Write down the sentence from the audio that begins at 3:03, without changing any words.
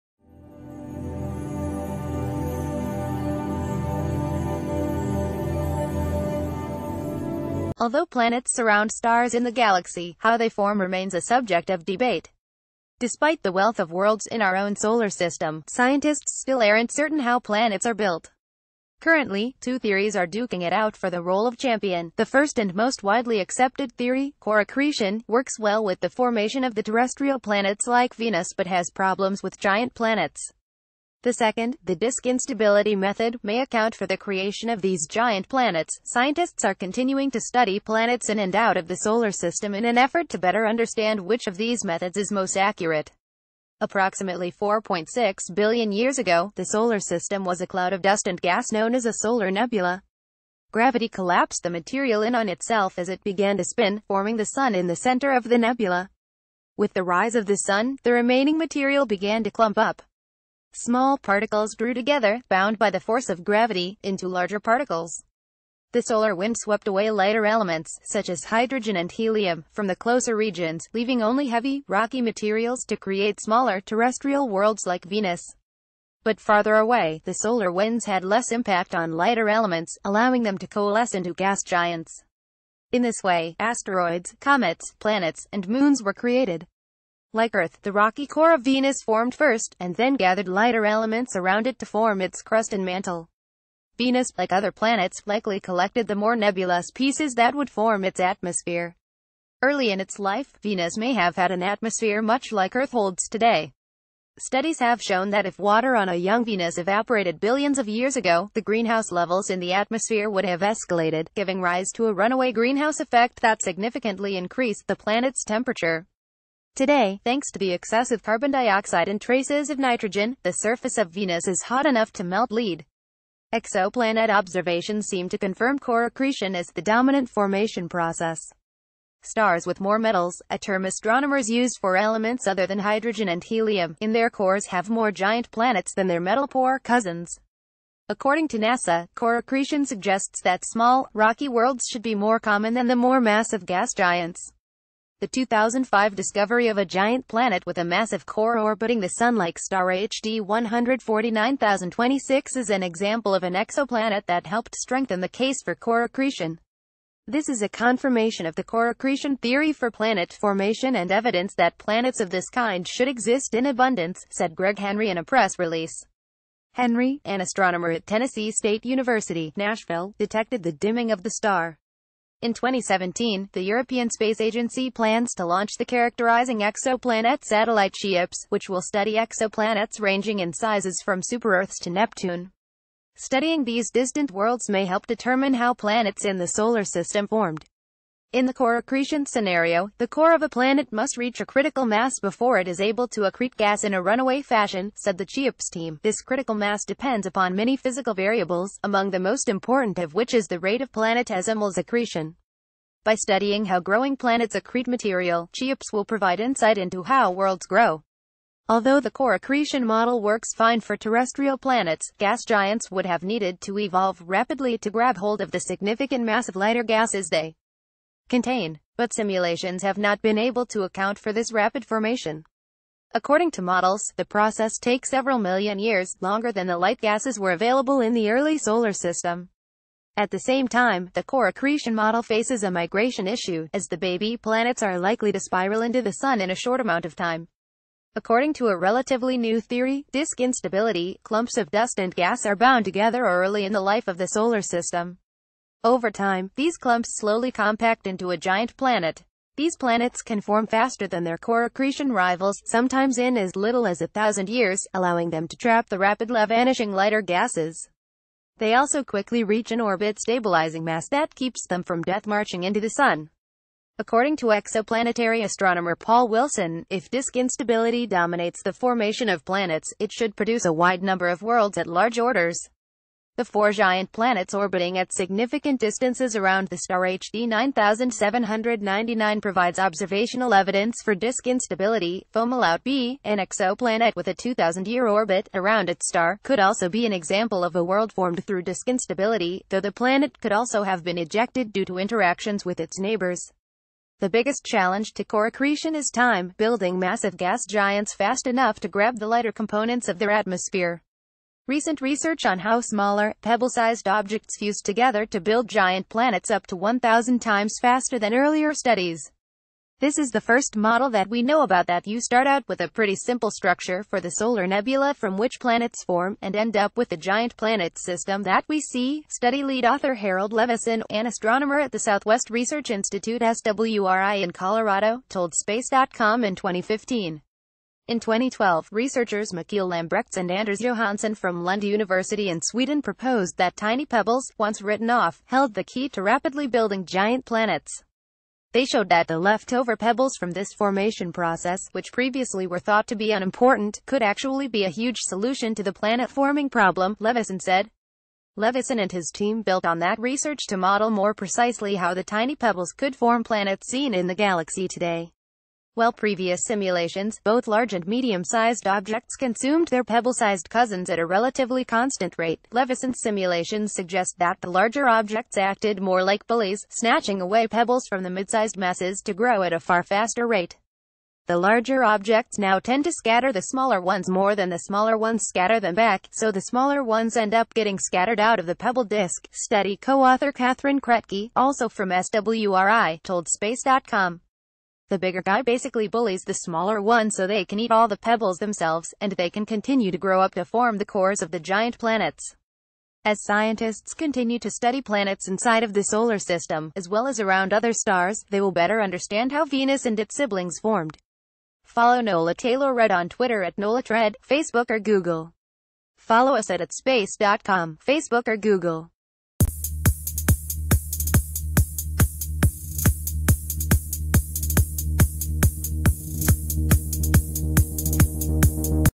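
Studying these distant worlds may help determine how planets in the solar system formed.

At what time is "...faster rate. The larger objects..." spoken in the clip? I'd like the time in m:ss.
6:10.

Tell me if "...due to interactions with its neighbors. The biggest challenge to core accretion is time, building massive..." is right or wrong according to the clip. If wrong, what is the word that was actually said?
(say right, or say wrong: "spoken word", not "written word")
right.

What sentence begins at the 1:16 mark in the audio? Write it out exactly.
But farther away, the solar winds had less impact on lighter elements, allowing them to coalesce into gas giants.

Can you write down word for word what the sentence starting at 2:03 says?
Exoplanet observations seem to confirm core accretion as the dominant formation process.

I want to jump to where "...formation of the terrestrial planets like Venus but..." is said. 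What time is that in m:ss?
0:26.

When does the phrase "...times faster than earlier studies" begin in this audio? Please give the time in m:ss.
5:07.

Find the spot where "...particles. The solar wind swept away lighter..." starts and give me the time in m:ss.
1:04.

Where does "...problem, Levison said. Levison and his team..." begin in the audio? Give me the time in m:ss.
5:46.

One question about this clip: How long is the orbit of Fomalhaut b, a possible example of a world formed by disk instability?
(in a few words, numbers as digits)
2,000 years.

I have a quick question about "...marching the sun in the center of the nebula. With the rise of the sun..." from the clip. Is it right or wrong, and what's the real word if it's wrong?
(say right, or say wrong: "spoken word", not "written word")
wrong: "forming", not "marching".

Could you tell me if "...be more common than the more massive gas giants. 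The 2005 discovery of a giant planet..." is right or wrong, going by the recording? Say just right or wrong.
right.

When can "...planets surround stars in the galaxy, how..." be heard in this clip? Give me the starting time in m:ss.
0:08.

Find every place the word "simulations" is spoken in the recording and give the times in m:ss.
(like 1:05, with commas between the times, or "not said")
3:39, 5:56, 6:03.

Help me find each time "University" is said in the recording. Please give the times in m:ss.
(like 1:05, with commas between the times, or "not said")
2:48, 5:31.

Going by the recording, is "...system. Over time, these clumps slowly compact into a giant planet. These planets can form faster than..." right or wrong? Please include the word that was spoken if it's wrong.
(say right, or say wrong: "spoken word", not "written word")
right.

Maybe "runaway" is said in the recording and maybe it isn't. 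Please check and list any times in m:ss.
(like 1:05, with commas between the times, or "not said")
1:52, 3:14.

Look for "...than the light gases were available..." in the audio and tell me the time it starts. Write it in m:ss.
3:46.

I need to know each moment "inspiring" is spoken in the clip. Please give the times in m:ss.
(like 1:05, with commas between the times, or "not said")
not said.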